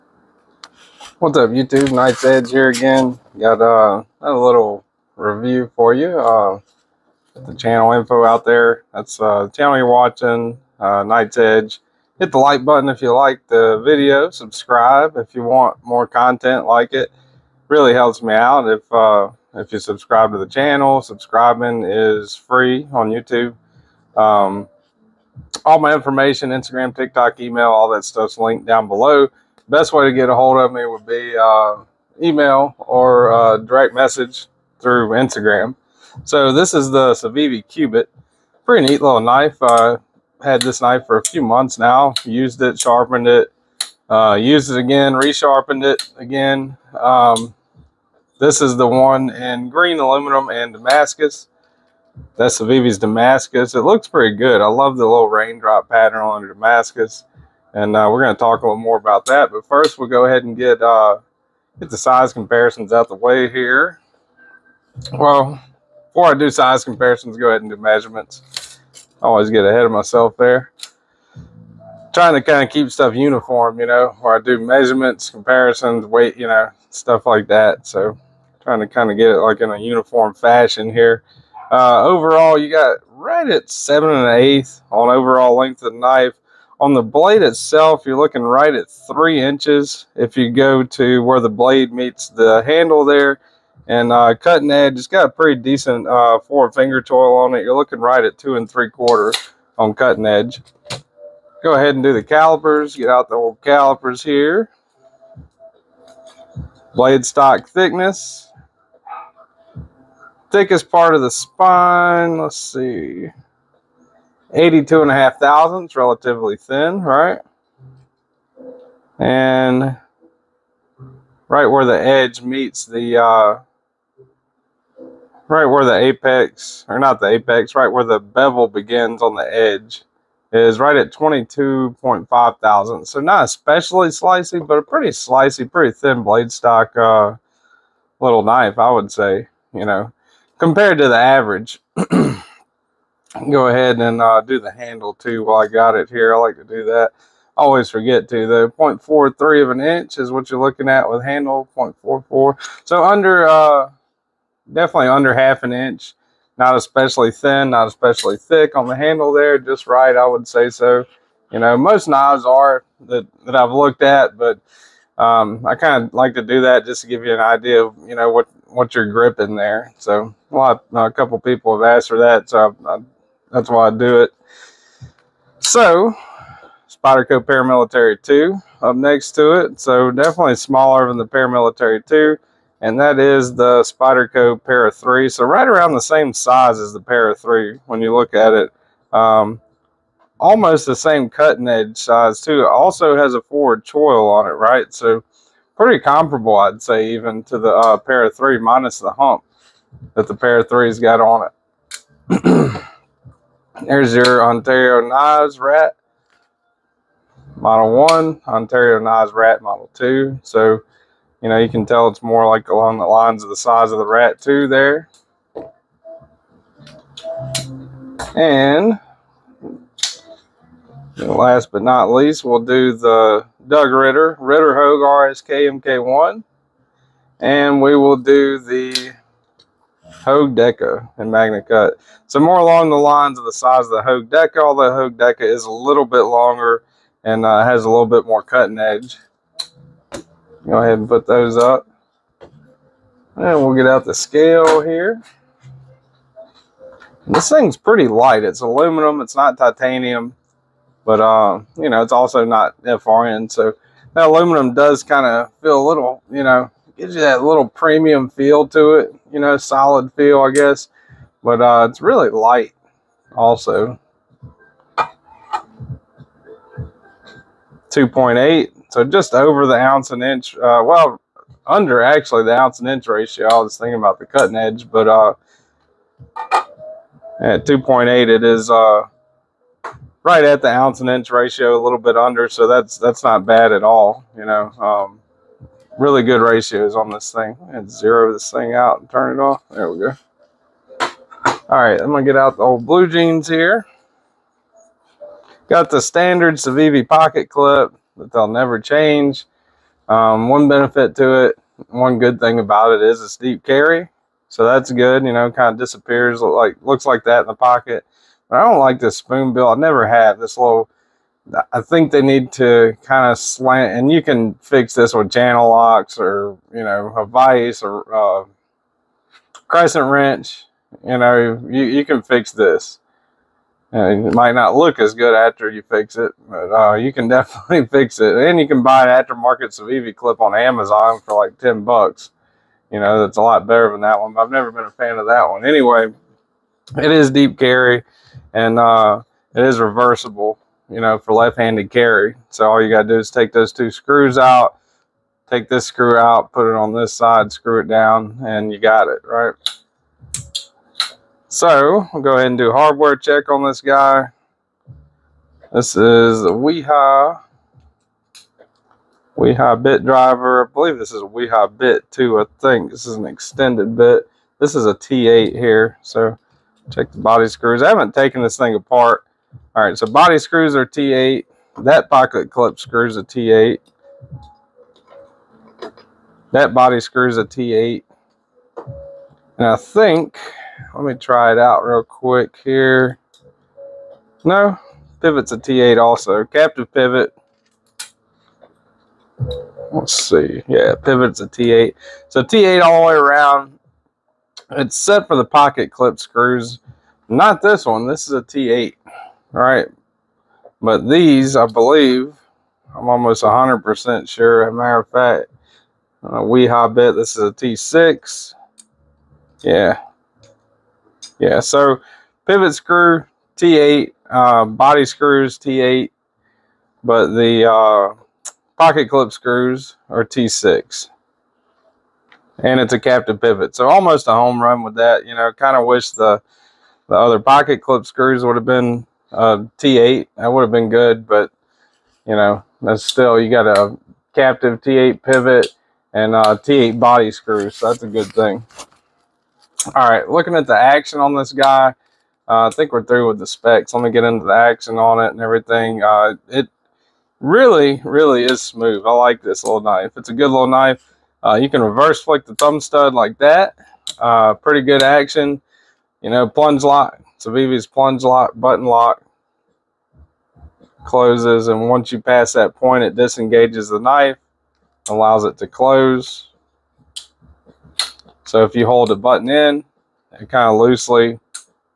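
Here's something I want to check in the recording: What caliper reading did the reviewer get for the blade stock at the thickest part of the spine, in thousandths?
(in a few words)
82.5 thousandths.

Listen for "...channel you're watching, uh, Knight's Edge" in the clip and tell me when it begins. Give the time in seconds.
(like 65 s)
9 s.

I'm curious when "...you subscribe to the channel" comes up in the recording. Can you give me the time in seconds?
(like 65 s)
19 s.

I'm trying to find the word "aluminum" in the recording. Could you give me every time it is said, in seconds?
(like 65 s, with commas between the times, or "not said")
49 s, 248 s, 254 s.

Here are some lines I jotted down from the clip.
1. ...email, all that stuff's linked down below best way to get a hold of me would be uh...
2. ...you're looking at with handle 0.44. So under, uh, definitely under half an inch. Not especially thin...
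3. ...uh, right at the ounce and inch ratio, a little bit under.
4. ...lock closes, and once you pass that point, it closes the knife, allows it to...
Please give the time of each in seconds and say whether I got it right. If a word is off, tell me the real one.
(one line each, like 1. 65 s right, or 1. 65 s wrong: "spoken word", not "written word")
1. 27 s right
2. 150 s right
3. 278 s right
4. 458 s wrong: "disengages", not "closes".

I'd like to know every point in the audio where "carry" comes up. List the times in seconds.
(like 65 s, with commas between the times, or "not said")
303 s, 337 s, 341 s.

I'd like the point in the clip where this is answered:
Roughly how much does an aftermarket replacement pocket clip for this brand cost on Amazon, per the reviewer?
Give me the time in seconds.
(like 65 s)
331 s.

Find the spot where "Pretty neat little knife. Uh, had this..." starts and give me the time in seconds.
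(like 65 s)
38 s.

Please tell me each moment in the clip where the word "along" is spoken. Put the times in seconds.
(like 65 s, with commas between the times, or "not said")
212 s, 232 s.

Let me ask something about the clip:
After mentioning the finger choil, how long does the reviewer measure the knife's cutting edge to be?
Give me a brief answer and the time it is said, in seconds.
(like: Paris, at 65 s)
2 3/4 inches, at 98 s.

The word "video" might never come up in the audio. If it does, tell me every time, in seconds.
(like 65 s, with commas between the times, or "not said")
13 s.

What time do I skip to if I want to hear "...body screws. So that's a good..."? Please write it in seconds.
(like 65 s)
436 s.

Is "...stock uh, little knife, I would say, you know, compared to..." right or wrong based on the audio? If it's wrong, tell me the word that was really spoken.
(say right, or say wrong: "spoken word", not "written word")
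right.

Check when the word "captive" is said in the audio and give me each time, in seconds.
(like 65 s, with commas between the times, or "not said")
386 s, 423 s, 434 s.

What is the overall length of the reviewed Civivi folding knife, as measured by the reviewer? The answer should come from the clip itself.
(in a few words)
7 1/8 inches.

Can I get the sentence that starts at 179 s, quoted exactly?
So definitely smaller than the Paramilitary 2.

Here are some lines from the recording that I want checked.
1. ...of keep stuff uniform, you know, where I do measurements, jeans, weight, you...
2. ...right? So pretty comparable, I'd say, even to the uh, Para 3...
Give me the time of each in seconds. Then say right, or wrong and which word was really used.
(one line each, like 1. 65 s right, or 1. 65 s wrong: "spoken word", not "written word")
1. 72 s wrong: "comparisons", not "jeans"
2. 194 s right.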